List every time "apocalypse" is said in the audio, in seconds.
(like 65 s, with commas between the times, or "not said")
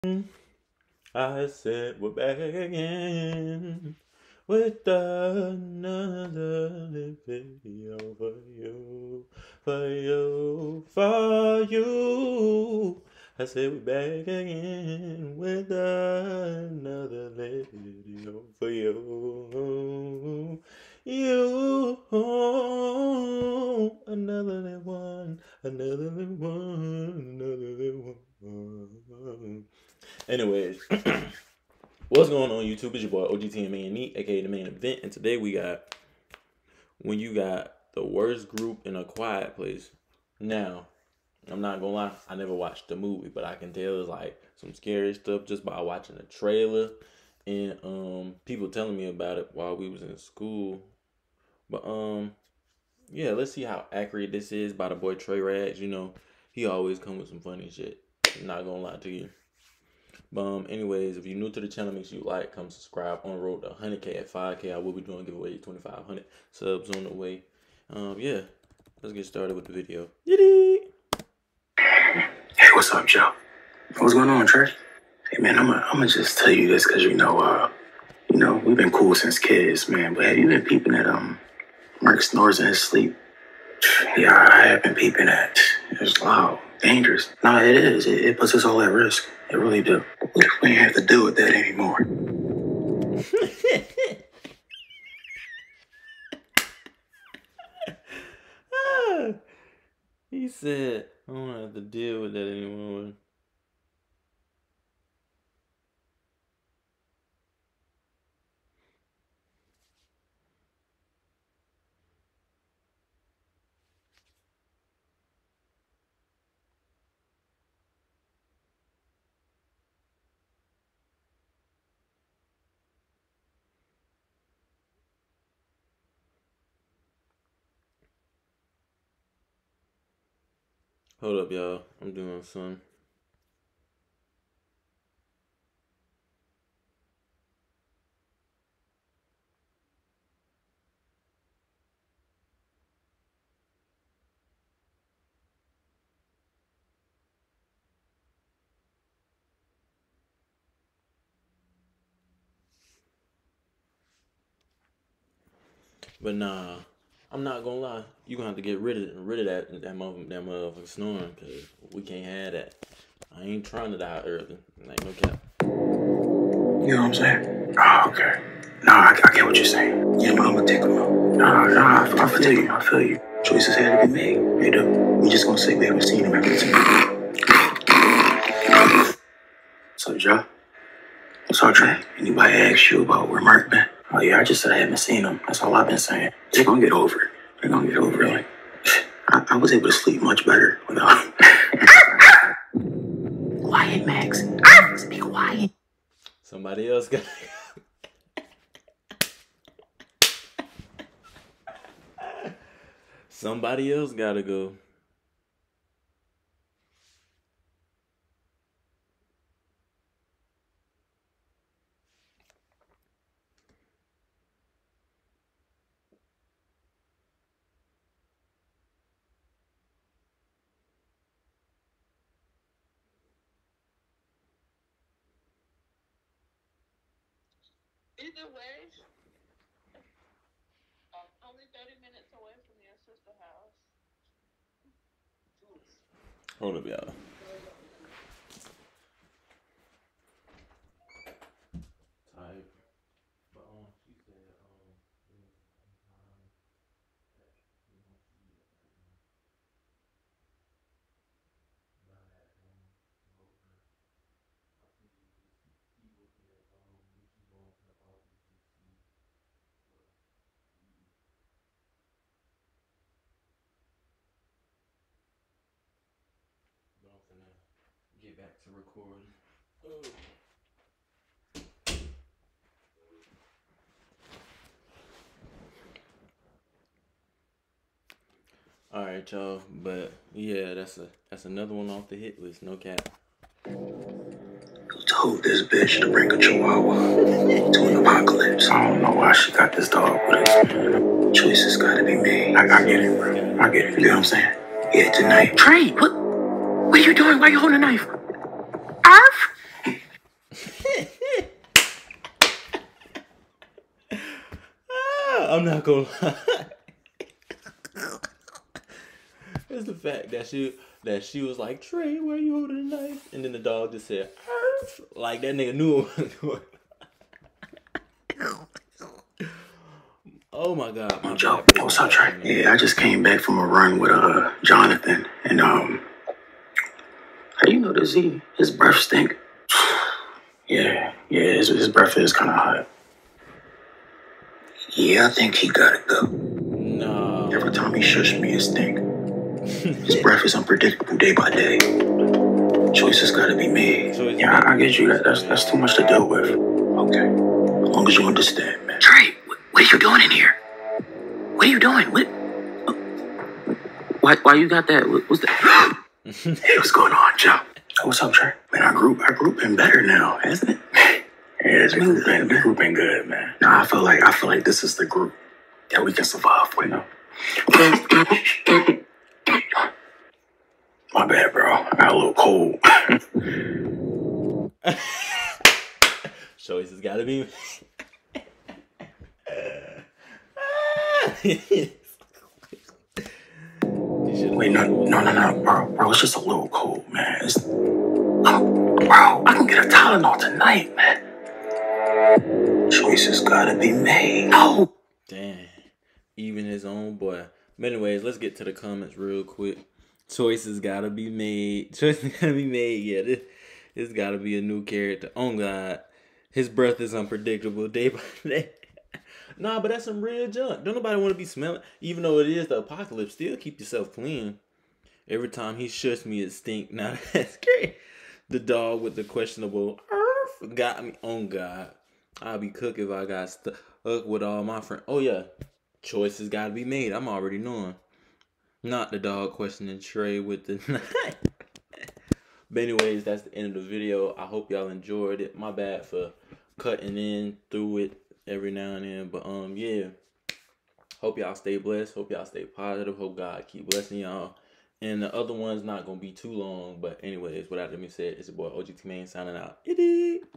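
287 s, 412 s.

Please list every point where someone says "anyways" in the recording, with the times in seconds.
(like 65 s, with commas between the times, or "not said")
30 s, 60 s, 397 s, 432 s, 447 s.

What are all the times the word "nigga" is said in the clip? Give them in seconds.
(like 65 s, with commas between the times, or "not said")
315 s.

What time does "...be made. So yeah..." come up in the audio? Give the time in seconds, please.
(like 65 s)
343 s.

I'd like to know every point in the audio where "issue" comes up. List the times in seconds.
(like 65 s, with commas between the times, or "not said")
not said.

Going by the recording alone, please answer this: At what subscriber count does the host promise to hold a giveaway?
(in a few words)
2,500.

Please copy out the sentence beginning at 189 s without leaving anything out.
I, I was able to sleep much better without.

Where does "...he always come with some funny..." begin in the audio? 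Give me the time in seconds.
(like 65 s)
56 s.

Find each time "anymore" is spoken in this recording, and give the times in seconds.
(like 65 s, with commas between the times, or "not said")
91 s, 102 s.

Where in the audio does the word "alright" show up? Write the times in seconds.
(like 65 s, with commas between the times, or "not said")
278 s.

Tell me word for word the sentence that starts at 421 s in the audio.
Oh God, I'll be cooked if I got stuck with all my friends.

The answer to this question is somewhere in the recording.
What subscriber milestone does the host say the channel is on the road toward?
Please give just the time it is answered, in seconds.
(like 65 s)
63 s.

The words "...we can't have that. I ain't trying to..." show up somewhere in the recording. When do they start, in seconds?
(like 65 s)
161 s.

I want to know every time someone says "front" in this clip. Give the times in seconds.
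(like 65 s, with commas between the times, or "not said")
not said.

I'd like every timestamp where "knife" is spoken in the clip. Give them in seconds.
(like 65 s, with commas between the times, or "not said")
297 s, 313 s, 430 s.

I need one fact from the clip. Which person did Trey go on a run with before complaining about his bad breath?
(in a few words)
Jonathan.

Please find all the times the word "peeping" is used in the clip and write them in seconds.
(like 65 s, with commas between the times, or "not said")
80 s, 84 s.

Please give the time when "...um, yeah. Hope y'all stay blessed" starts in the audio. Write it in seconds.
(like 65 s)
439 s.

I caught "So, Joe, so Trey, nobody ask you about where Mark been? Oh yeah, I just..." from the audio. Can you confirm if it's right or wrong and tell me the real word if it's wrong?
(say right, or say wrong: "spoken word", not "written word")
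wrong: "anybody", not "nobody".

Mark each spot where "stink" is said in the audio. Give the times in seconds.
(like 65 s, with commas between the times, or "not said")
328 s, 338 s, 416 s.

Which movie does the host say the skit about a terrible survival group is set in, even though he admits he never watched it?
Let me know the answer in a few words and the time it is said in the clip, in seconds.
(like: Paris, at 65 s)
A Quiet Place, at 38 s.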